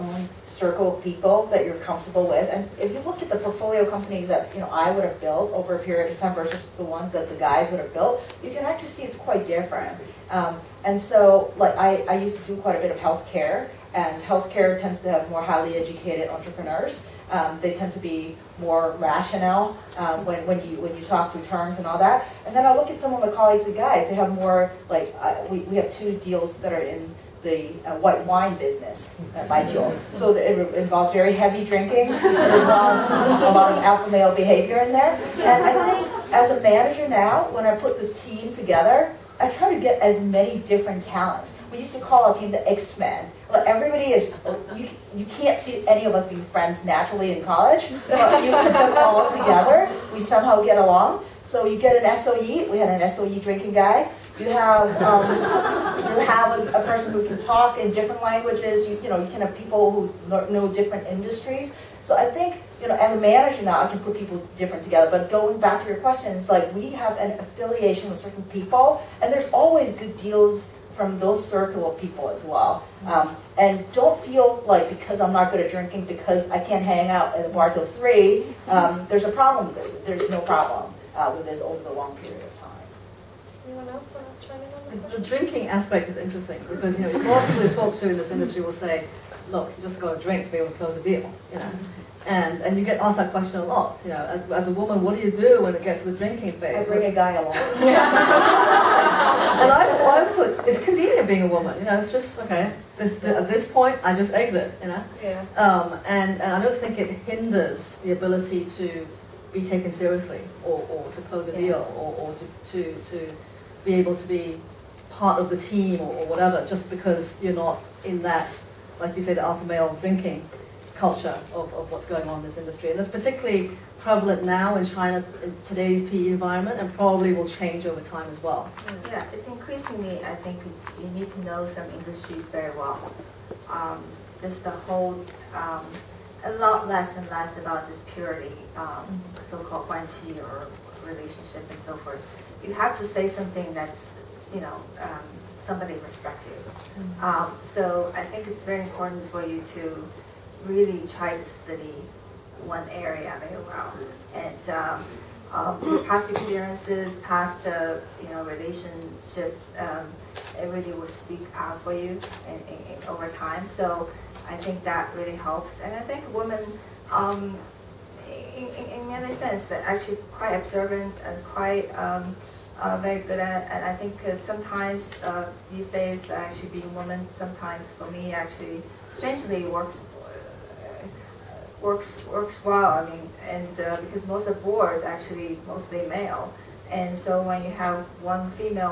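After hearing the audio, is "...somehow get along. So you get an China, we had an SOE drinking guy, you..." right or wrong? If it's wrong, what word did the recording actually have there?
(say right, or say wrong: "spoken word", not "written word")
wrong: "SOE", not "China".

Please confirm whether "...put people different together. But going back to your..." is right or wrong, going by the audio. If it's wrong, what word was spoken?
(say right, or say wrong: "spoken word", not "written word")
right.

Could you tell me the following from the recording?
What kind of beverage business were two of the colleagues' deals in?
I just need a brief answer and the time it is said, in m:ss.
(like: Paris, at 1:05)
white wine, at 0:27.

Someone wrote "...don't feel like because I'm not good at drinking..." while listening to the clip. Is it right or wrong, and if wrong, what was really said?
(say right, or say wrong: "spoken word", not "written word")
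right.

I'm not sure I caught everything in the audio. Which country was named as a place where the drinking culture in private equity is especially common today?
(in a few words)
China.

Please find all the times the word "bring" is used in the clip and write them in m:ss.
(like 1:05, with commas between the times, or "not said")
1:36.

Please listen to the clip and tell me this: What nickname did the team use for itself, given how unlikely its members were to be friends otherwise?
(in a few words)
X-Men.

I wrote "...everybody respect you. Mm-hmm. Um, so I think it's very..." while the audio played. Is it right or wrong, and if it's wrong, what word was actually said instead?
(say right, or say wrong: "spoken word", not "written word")
wrong: "somebody", not "everybody".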